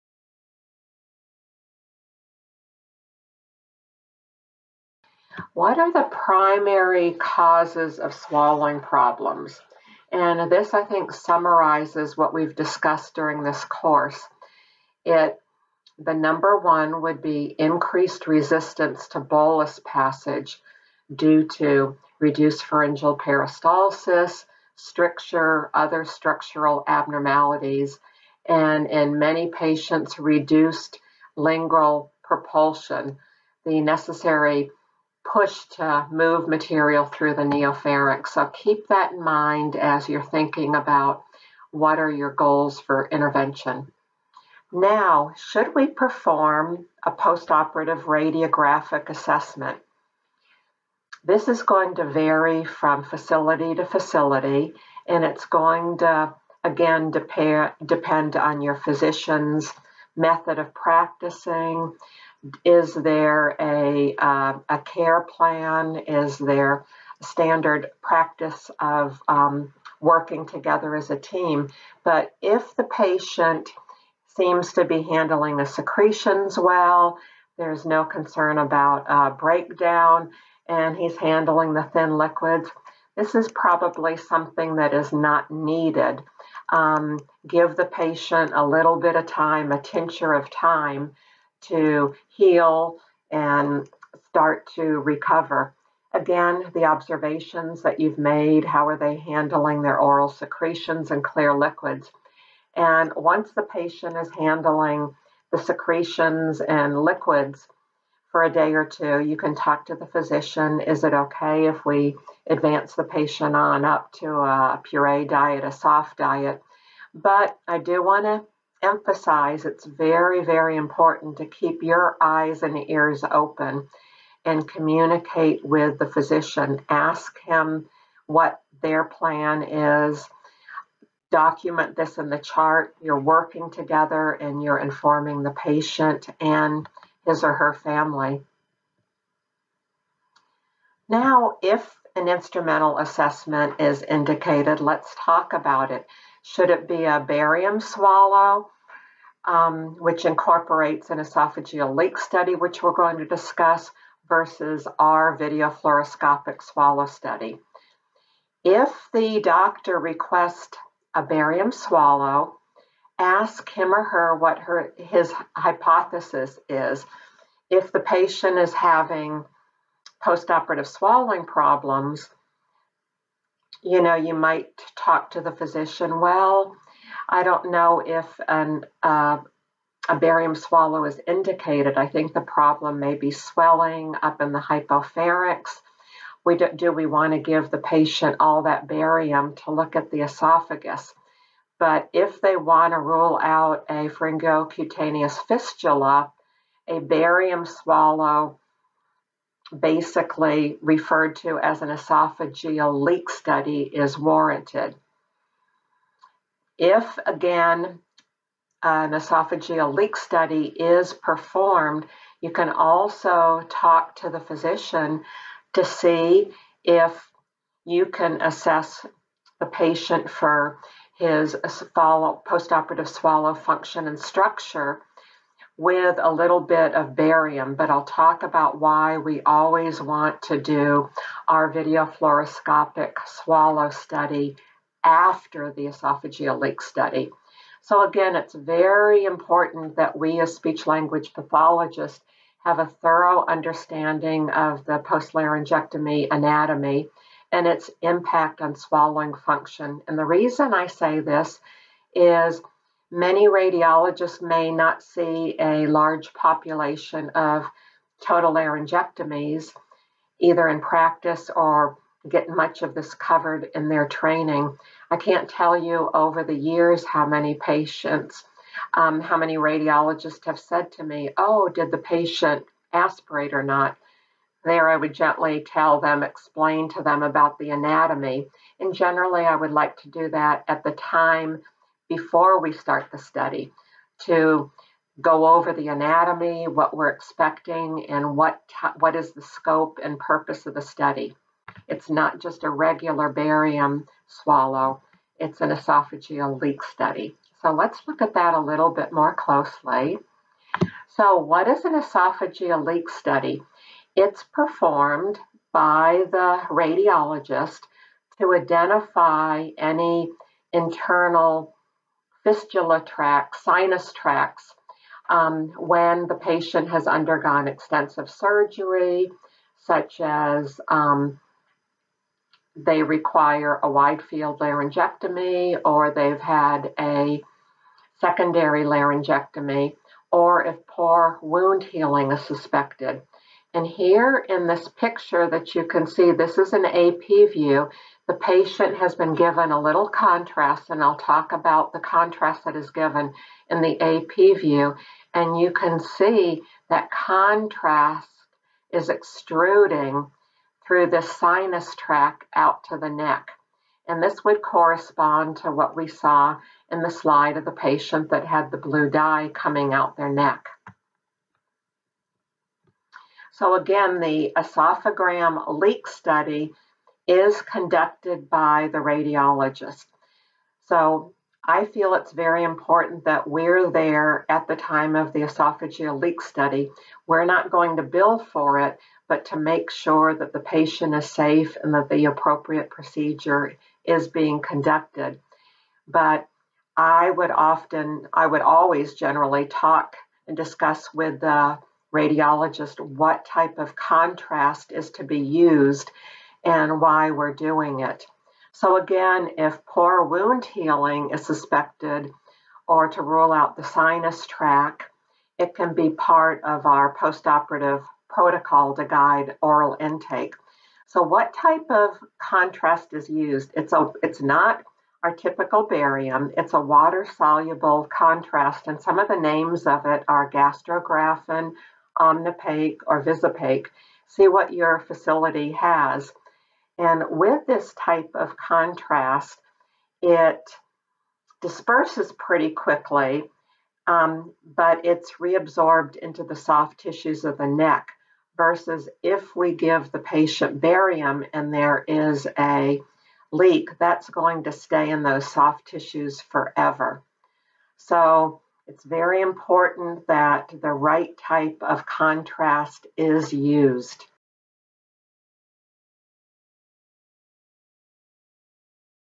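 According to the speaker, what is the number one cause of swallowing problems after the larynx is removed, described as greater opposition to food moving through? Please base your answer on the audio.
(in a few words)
Increased resistance to bolus passage.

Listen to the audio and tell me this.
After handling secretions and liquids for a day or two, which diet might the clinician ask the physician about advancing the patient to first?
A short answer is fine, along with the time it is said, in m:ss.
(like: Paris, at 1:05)
Puree diet, at 1:54.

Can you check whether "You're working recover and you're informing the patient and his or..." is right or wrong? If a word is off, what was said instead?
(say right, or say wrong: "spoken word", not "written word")
wrong: "together", not "recover".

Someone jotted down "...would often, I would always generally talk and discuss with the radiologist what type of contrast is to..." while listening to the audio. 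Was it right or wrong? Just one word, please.
right.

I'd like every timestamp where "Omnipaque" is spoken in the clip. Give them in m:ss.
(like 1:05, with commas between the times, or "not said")
7:02.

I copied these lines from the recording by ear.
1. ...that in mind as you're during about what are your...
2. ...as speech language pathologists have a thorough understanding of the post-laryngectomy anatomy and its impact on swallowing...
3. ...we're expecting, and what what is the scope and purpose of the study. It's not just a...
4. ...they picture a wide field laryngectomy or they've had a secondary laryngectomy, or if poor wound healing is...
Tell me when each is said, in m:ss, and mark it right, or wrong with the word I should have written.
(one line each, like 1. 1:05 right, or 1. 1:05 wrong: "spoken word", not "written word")
1. 0:38 wrong: "thinking", not "during"
2. 4:00 right
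3. 4:46 right
4. 5:22 wrong: "require", not "picture".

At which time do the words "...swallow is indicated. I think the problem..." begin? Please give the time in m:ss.
3:00.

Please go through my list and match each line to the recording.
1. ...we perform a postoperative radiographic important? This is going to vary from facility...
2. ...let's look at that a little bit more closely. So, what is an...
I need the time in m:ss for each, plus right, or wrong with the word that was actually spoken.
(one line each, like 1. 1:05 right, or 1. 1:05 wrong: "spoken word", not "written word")
1. 0:45 wrong: "assessment", not "important"
2. 4:57 right.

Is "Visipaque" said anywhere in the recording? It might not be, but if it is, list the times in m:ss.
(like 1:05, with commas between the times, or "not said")
7:03.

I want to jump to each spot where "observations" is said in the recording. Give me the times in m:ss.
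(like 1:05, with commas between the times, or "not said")
1:36.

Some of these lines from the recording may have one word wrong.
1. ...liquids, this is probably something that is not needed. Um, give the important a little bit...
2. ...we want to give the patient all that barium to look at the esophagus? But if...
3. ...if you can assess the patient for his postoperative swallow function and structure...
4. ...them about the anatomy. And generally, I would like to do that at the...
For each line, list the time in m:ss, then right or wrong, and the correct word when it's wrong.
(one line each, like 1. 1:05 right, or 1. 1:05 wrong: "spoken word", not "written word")
1. 1:22 wrong: "patient", not "important"
2. 3:06 right
3. 3:36 right
4. 4:37 right.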